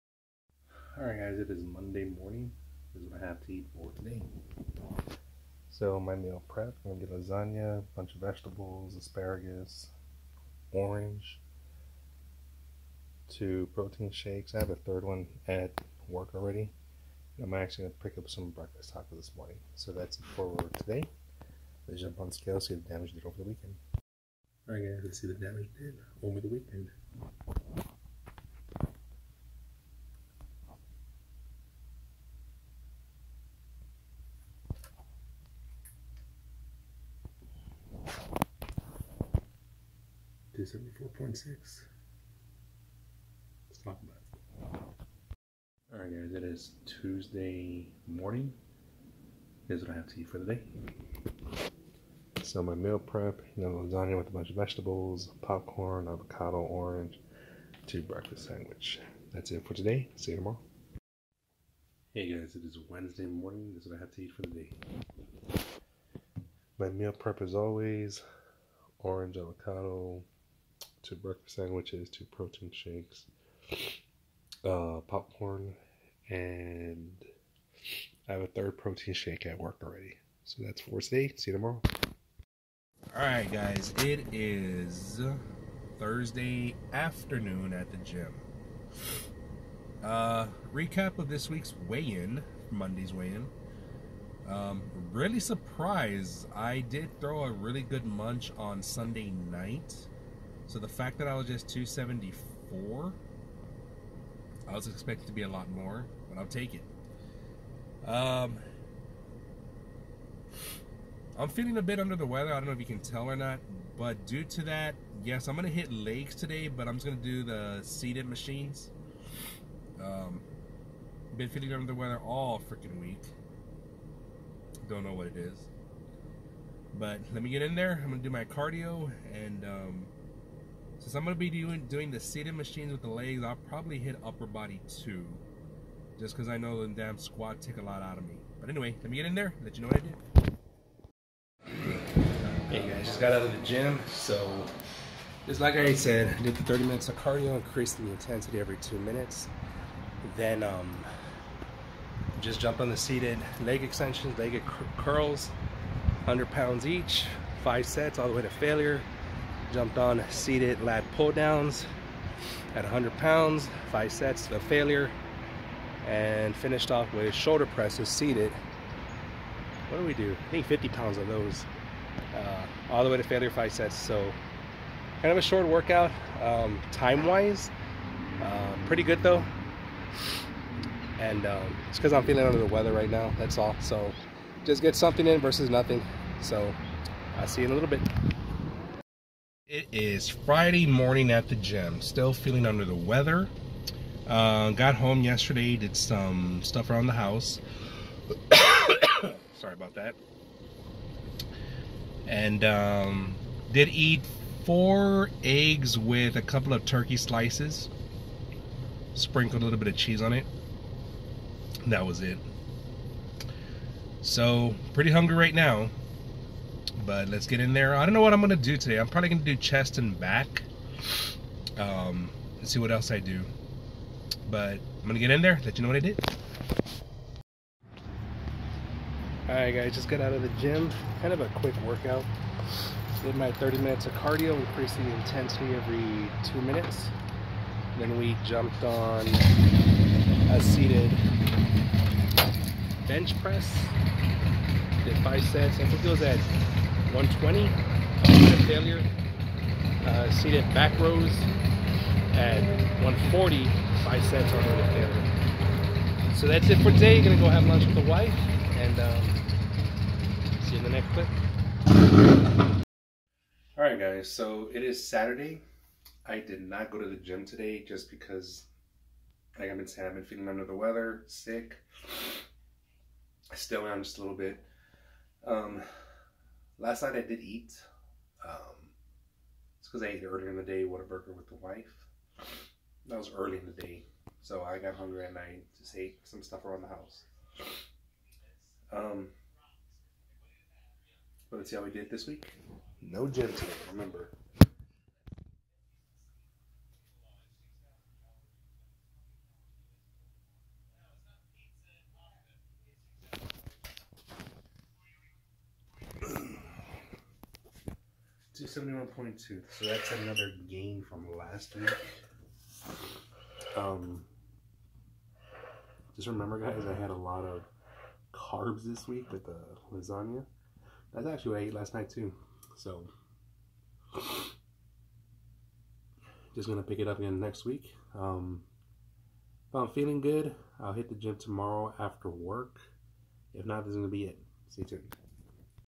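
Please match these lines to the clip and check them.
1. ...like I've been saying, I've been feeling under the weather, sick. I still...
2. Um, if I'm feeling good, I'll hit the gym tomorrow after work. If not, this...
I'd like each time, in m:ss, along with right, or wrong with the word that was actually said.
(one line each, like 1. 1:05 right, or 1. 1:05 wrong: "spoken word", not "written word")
1. 4:29 right
2. 5:28 right.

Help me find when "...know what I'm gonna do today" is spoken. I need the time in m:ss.
3:38.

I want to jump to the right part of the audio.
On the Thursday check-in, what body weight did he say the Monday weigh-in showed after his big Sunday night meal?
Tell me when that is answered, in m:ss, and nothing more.
1:41.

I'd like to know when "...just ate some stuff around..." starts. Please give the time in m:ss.
4:45.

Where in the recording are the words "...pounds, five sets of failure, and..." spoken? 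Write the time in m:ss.
2:43.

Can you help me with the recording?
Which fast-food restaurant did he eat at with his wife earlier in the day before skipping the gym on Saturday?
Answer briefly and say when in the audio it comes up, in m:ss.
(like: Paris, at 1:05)
Whataburger, at 4:40.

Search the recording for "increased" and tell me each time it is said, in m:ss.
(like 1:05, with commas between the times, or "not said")
2:27, 3:54.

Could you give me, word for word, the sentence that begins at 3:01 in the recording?
And um, it's because I'm feeling under the weather right now.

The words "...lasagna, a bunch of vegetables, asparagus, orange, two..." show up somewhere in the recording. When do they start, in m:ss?
0:07.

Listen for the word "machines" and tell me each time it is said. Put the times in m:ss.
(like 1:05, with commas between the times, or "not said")
1:58, 2:12.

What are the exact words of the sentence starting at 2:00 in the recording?
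Um, been feeling under the weather all freaking week.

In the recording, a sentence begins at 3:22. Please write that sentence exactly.
And um, did eat four eggs with a couple of turkey slices.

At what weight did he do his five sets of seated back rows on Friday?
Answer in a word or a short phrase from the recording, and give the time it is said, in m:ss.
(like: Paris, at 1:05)
140, at 4:13.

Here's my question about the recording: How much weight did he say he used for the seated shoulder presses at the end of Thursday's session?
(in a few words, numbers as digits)
50 pounds.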